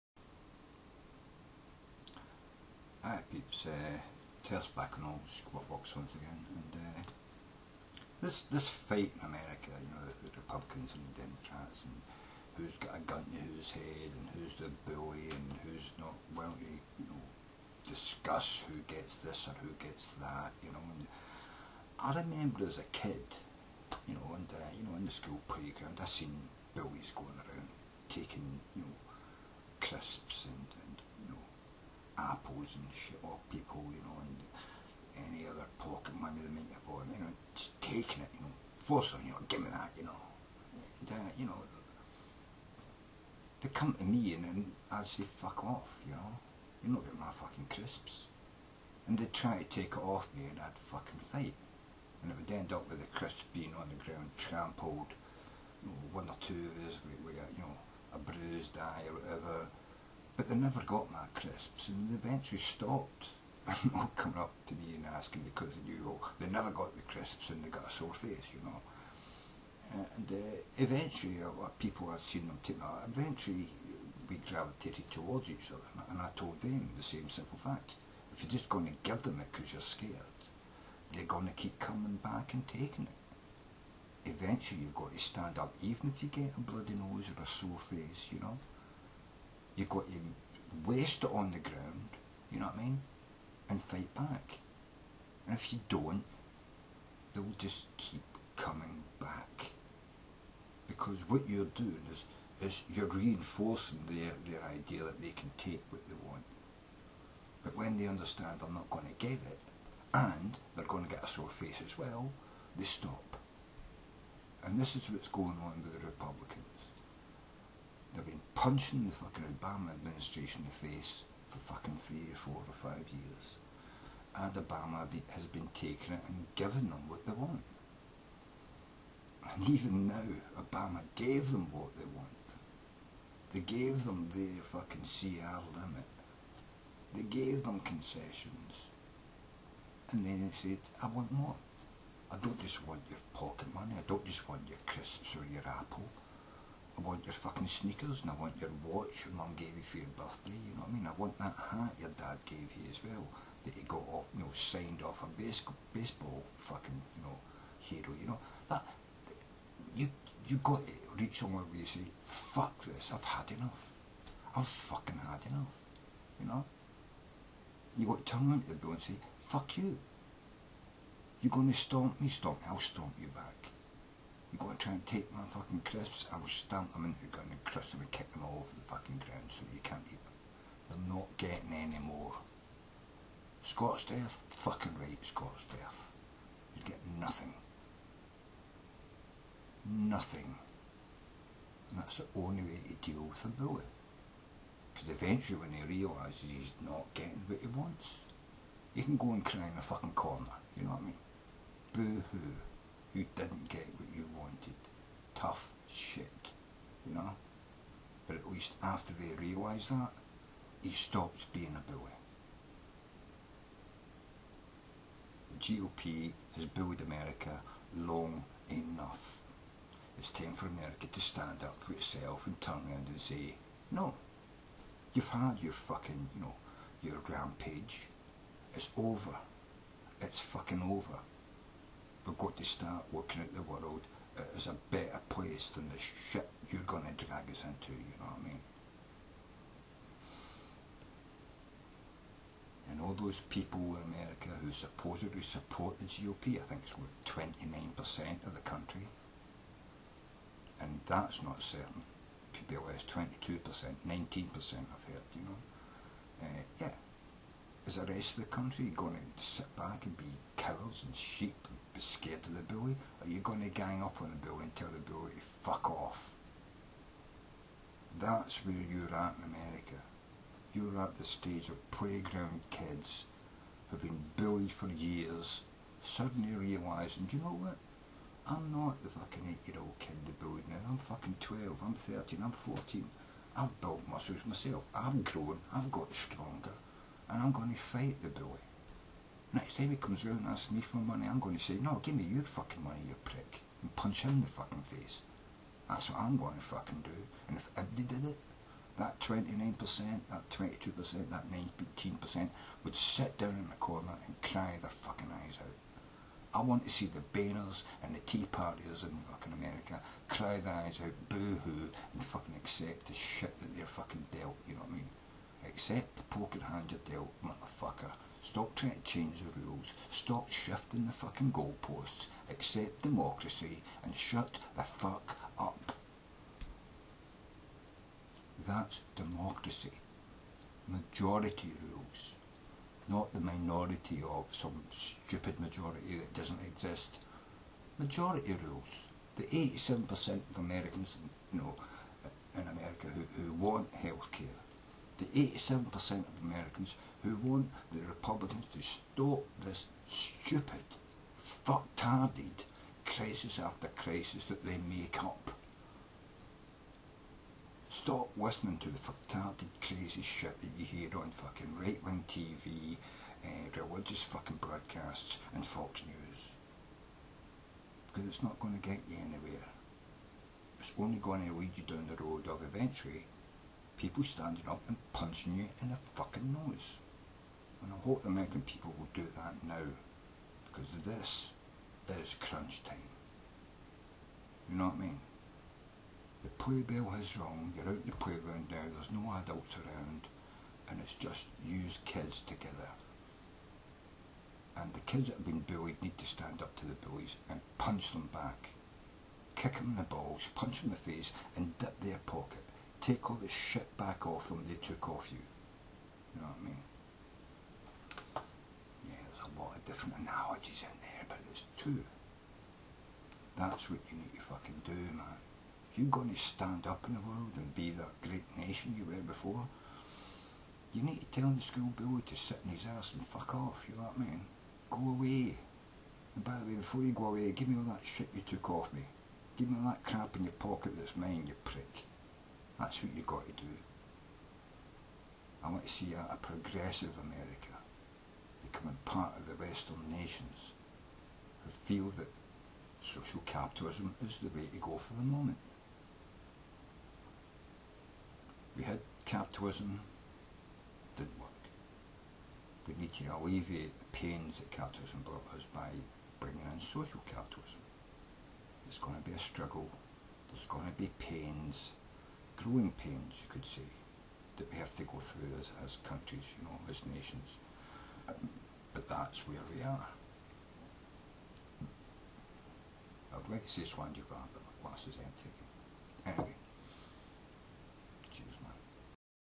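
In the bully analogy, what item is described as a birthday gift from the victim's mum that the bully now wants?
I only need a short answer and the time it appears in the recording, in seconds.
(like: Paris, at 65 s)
watch, at 148 s.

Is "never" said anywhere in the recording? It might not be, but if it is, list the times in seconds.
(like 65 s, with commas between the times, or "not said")
60 s, 66 s.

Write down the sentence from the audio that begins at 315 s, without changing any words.
Accept the poker hand you're dealt, motherfucker.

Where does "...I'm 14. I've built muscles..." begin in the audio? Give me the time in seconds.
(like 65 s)
282 s.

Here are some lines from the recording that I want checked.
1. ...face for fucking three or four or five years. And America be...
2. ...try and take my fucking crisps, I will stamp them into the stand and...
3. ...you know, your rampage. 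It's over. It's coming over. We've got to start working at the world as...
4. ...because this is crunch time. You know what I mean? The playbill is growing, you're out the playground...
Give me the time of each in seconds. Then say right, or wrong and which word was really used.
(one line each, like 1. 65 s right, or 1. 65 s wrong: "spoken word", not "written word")
1. 120 s wrong: "Obama", not "America"
2. 174 s wrong: "ground", not "stand"
3. 226 s wrong: "fucking", not "coming"
4. 380 s wrong: "wrong", not "growing".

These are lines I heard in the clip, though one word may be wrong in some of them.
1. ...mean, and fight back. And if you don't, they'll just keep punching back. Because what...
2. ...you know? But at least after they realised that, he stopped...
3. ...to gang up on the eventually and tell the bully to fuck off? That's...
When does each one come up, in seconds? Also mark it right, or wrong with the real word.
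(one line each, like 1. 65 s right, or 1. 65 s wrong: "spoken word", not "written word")
1. 92 s wrong: "coming", not "punching"
2. 207 s right
3. 263 s wrong: "bully", not "eventually".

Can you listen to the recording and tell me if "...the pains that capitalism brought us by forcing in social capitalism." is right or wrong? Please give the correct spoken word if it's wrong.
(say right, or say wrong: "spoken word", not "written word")
wrong: "bringing", not "forcing".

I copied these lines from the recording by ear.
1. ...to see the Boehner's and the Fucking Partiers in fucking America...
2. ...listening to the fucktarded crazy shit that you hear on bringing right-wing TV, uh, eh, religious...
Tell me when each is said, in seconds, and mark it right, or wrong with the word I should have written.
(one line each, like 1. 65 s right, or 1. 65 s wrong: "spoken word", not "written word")
1. 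306 s wrong: "Tea", not "Fucking"
2. 358 s wrong: "fucking", not "bringing".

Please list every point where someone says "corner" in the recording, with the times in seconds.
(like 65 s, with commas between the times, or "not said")
200 s, 303 s.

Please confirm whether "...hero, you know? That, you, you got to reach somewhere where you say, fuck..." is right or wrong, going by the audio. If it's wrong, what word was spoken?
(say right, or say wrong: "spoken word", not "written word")
right.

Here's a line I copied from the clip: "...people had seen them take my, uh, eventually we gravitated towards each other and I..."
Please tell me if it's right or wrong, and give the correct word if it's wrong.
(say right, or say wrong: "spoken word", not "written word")
right.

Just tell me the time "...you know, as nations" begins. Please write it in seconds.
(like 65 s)
466 s.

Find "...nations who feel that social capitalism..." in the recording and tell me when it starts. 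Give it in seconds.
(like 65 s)
440 s.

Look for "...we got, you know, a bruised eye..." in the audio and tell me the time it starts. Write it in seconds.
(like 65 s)
57 s.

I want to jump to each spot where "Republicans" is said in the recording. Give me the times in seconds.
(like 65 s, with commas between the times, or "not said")
10 s, 116 s, 348 s.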